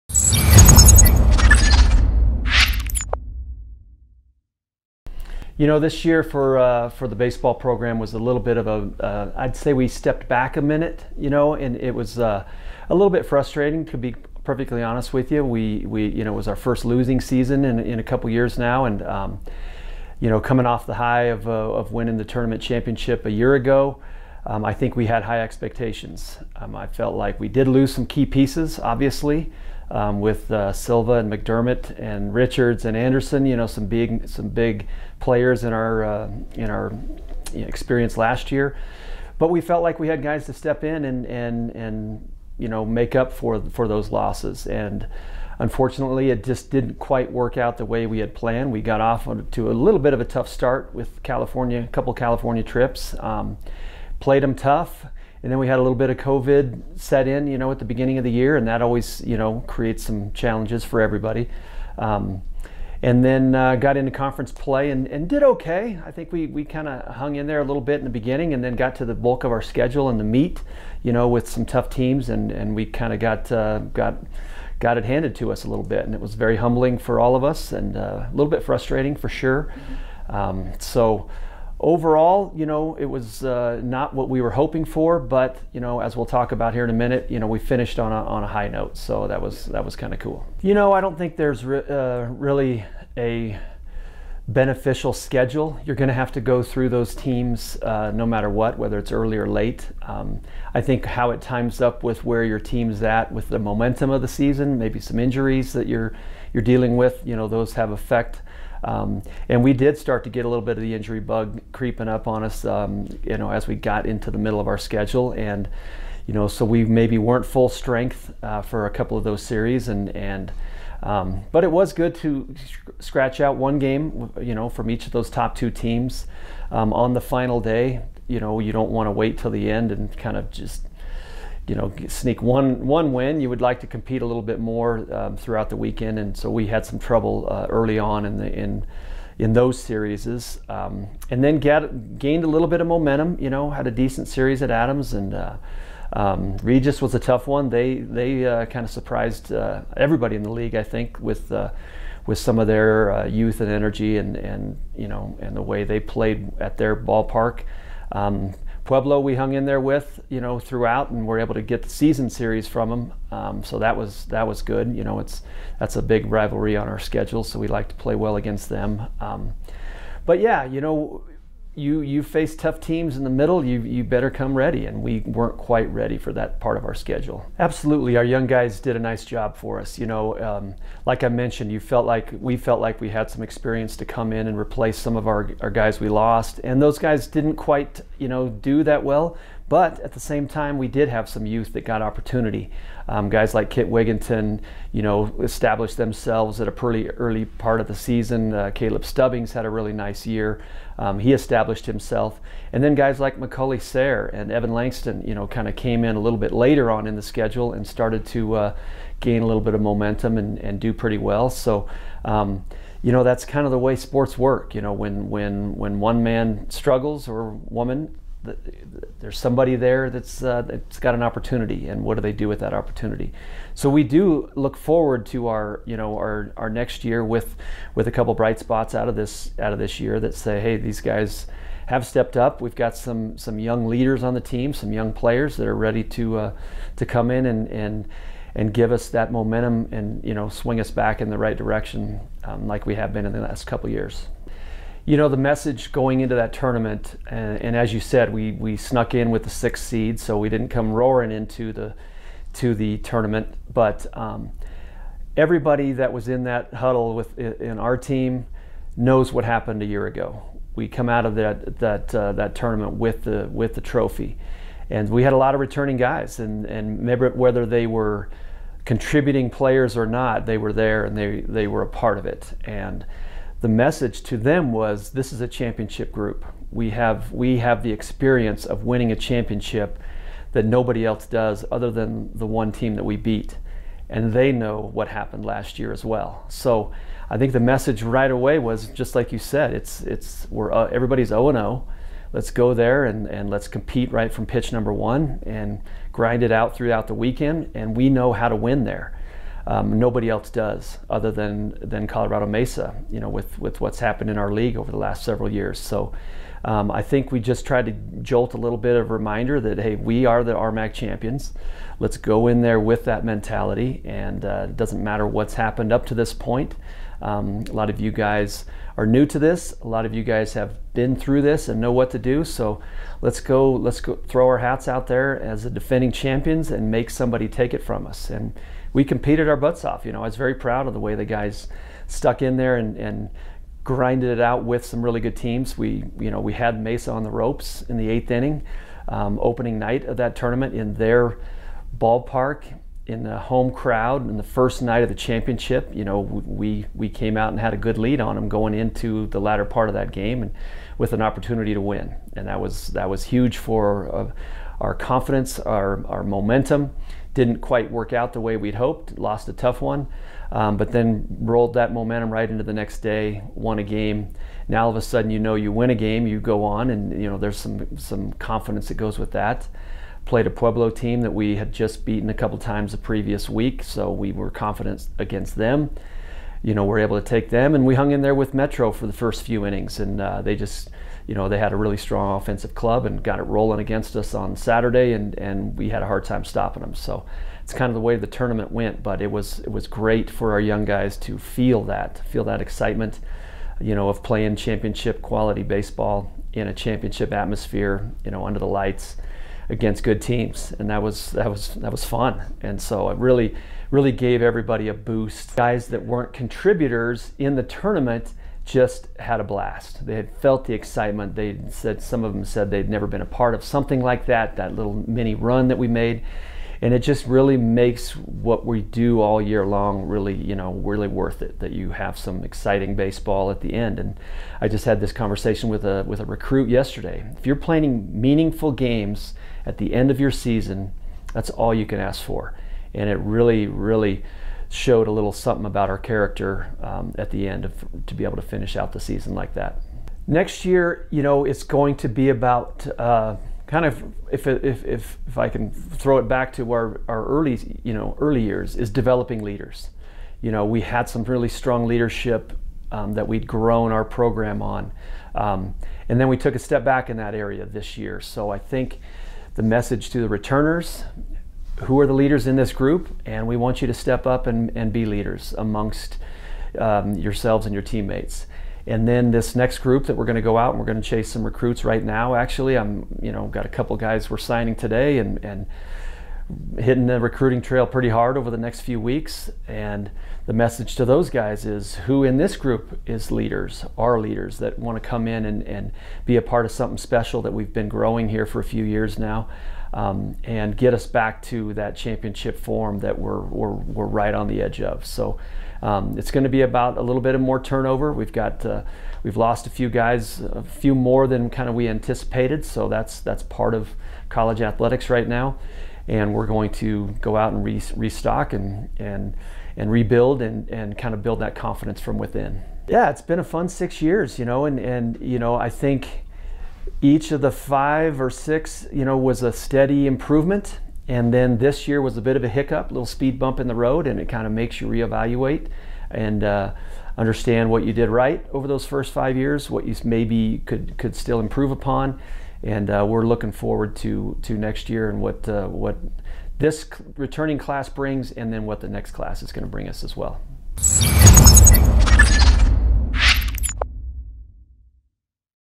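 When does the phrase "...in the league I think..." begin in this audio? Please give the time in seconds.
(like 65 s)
150 s.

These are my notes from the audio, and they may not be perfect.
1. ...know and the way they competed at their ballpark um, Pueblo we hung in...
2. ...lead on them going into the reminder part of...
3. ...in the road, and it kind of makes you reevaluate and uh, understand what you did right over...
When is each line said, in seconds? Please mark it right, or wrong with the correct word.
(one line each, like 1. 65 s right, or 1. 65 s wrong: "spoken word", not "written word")
1. 155 s wrong: "played", not "competed"
2. 347 s wrong: "latter", not "reminder"
3. 523 s right.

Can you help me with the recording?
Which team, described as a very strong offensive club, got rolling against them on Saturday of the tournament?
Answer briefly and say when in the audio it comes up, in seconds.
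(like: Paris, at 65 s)
Metro, at 378 s.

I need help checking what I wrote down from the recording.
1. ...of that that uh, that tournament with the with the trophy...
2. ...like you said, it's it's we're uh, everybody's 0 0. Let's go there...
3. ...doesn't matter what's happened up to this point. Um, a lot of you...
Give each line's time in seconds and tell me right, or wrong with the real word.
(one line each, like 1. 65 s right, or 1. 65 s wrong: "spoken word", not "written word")
1. 261 s right
2. 289 s right
3. 314 s right.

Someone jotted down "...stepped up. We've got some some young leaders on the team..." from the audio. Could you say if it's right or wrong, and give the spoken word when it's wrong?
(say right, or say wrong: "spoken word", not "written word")
right.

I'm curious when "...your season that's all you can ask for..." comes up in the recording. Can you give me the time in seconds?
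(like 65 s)
430 s.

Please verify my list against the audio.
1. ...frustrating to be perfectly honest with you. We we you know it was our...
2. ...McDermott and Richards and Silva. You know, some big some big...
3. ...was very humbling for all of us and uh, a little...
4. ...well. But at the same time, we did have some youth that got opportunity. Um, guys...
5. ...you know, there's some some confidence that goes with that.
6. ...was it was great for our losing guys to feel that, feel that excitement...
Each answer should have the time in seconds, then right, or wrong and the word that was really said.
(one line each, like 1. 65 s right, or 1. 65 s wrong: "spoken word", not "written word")
1. 13 s right
2. 31 s wrong: "Anderson", not "Silva"
3. 76 s right
4. 189 s right
5. 367 s right
6. 389 s wrong: "young", not "losing".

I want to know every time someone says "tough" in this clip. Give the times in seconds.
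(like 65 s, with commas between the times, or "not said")
50 s, 54 s, 71 s, 147 s, 172 s, 359 s.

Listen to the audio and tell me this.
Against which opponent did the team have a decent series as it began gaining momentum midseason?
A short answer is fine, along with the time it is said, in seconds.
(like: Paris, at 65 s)
Adams, at 144 s.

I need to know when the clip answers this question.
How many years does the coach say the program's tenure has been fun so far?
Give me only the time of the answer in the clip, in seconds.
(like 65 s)
513 s.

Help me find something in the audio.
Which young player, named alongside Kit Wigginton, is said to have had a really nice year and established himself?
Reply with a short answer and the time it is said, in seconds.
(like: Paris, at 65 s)
Caleb Stubbings, at 198 s.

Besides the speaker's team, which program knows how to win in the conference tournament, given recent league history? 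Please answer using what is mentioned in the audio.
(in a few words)
Colorado Mesa.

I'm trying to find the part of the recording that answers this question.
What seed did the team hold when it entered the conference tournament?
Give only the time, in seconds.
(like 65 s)
249 s.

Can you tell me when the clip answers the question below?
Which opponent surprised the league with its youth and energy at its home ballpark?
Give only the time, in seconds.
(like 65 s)
146 s.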